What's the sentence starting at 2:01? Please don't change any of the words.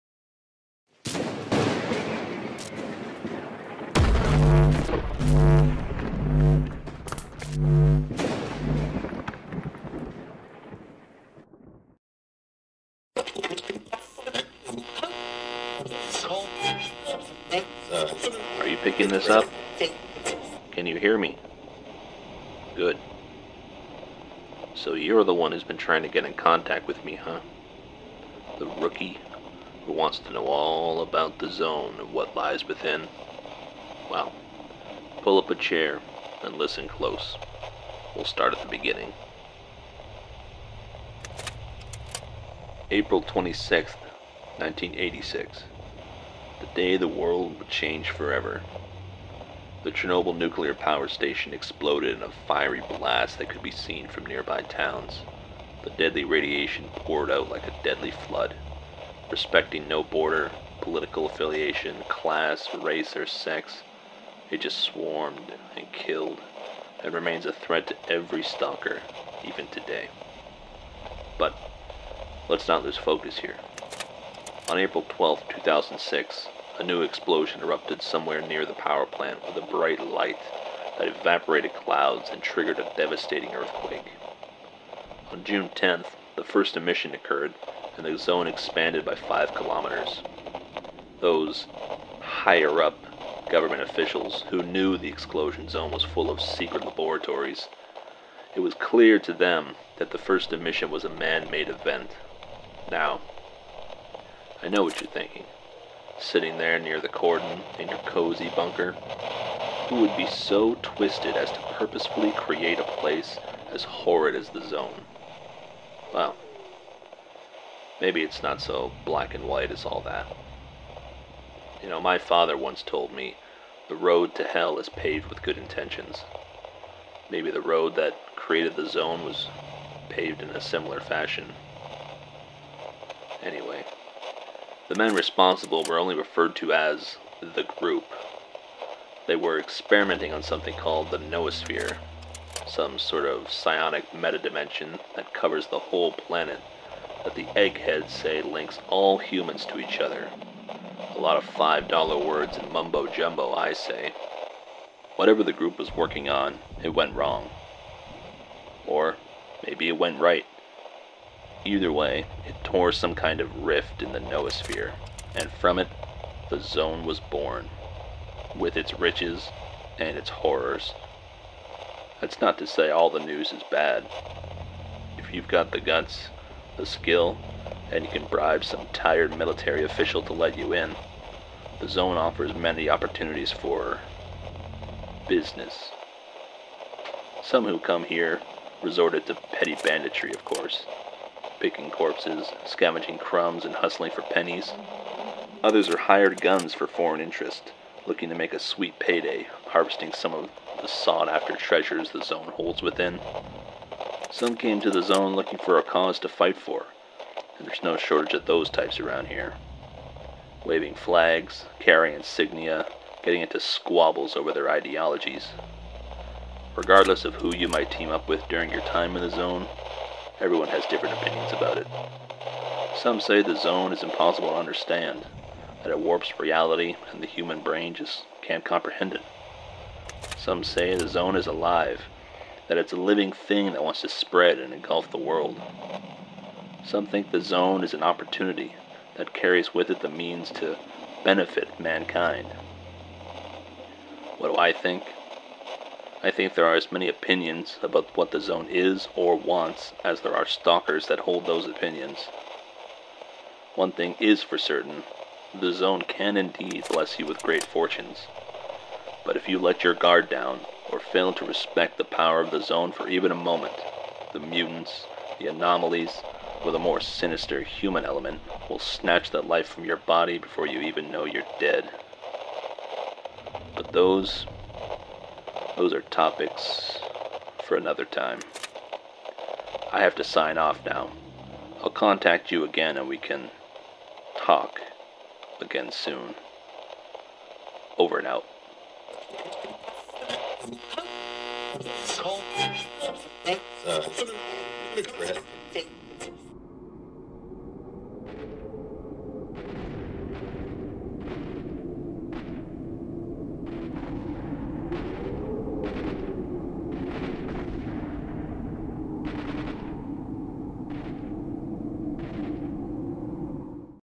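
You know, my father once told me the road to hell is paved with good intentions.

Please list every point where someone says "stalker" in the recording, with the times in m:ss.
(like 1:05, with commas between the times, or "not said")
1:08, 4:10.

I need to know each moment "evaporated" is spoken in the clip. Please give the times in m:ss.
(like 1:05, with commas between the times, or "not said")
1:21.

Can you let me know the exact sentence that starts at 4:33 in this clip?
But those those are topics for another time.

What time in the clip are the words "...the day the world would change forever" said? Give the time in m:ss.
0:46.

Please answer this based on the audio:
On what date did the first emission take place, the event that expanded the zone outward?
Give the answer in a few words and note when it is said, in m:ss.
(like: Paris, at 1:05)
June 10th, at 1:25.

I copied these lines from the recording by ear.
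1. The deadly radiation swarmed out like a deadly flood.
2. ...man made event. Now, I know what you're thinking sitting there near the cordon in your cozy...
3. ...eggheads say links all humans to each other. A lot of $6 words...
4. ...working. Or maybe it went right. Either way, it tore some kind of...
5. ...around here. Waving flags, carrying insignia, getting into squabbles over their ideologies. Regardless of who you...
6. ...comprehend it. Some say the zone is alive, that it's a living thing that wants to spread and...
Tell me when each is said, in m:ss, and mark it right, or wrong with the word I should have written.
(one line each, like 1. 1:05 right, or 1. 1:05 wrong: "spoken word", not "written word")
1. 0:55 wrong: "poured", not "swarmed"
2. 1:41 right
3. 2:27 wrong: "5", not "6"
4. 2:37 wrong: "wrong", not "working"
5. 3:28 right
6. 3:48 right.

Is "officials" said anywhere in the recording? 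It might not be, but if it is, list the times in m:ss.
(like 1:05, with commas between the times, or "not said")
1:33, 2:59.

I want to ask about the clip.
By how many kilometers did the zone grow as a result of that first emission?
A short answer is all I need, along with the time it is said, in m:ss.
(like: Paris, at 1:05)
5 kilometers, at 1:29.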